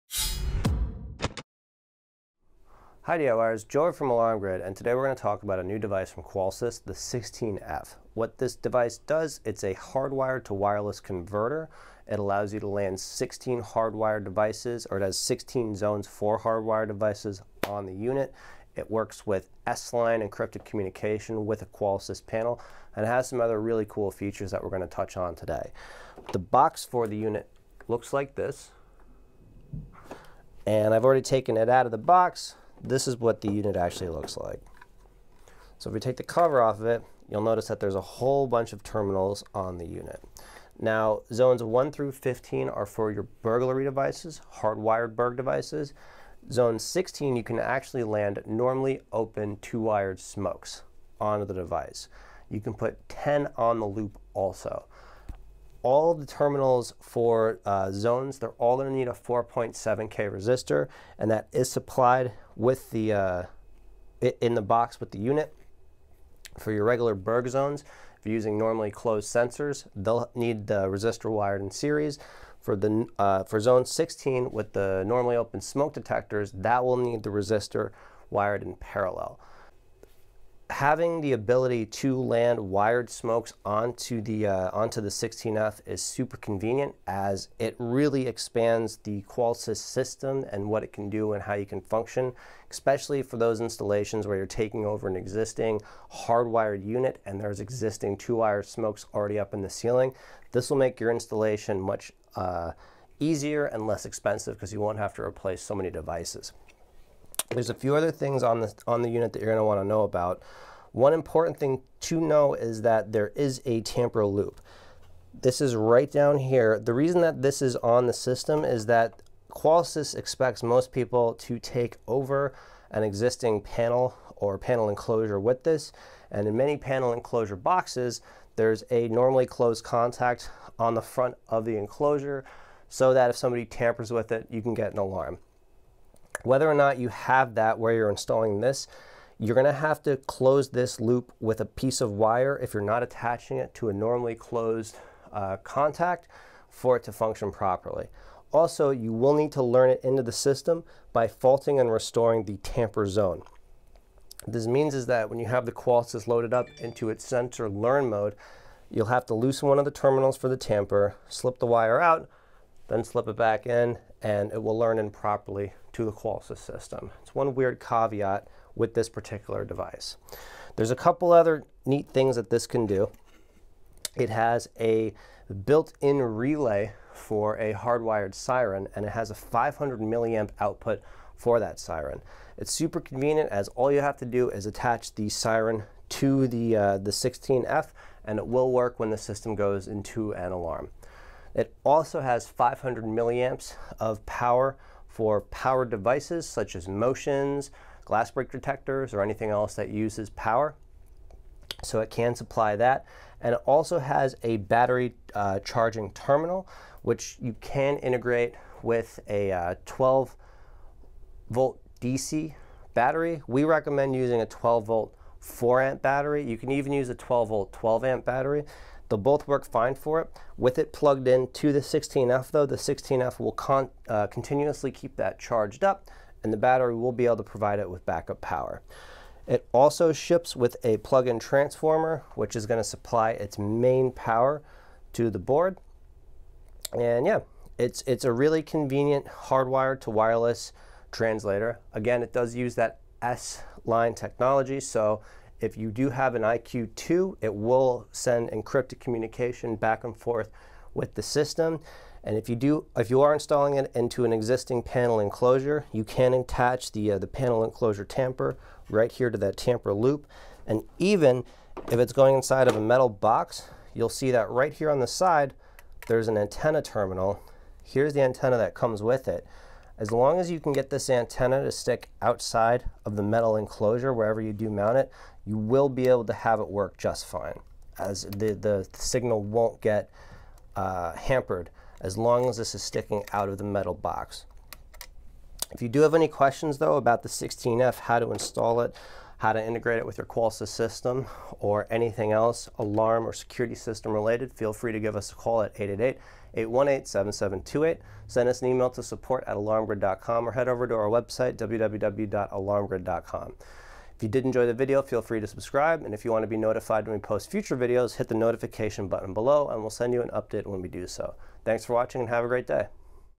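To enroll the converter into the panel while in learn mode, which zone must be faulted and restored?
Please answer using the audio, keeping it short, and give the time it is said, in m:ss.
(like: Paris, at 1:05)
tamper zone, at 2:32.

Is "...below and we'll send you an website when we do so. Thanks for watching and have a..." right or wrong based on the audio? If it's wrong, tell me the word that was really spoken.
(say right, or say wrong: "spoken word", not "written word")
wrong: "update", not "website".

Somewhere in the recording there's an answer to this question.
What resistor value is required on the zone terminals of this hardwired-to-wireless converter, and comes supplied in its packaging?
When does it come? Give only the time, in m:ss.
0:59.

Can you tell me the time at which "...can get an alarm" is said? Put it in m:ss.
2:14.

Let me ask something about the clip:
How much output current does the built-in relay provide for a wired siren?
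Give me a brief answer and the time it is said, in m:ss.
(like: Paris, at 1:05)
500 milliamps, at 2:59.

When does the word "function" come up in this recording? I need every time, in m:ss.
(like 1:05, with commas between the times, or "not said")
1:31, 2:27.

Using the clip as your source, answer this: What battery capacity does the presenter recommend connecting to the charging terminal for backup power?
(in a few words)
4 amp.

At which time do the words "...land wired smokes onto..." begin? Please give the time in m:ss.
1:22.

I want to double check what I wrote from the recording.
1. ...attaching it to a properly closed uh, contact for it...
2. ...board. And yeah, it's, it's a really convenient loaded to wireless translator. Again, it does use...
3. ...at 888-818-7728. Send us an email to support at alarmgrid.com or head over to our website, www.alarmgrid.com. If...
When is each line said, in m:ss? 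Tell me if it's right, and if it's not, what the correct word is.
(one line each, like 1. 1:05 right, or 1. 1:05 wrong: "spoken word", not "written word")
1. 2:23 wrong: "normally", not "properly"
2. 3:55 wrong: "hardwired", not "loaded"
3. 4:55 right.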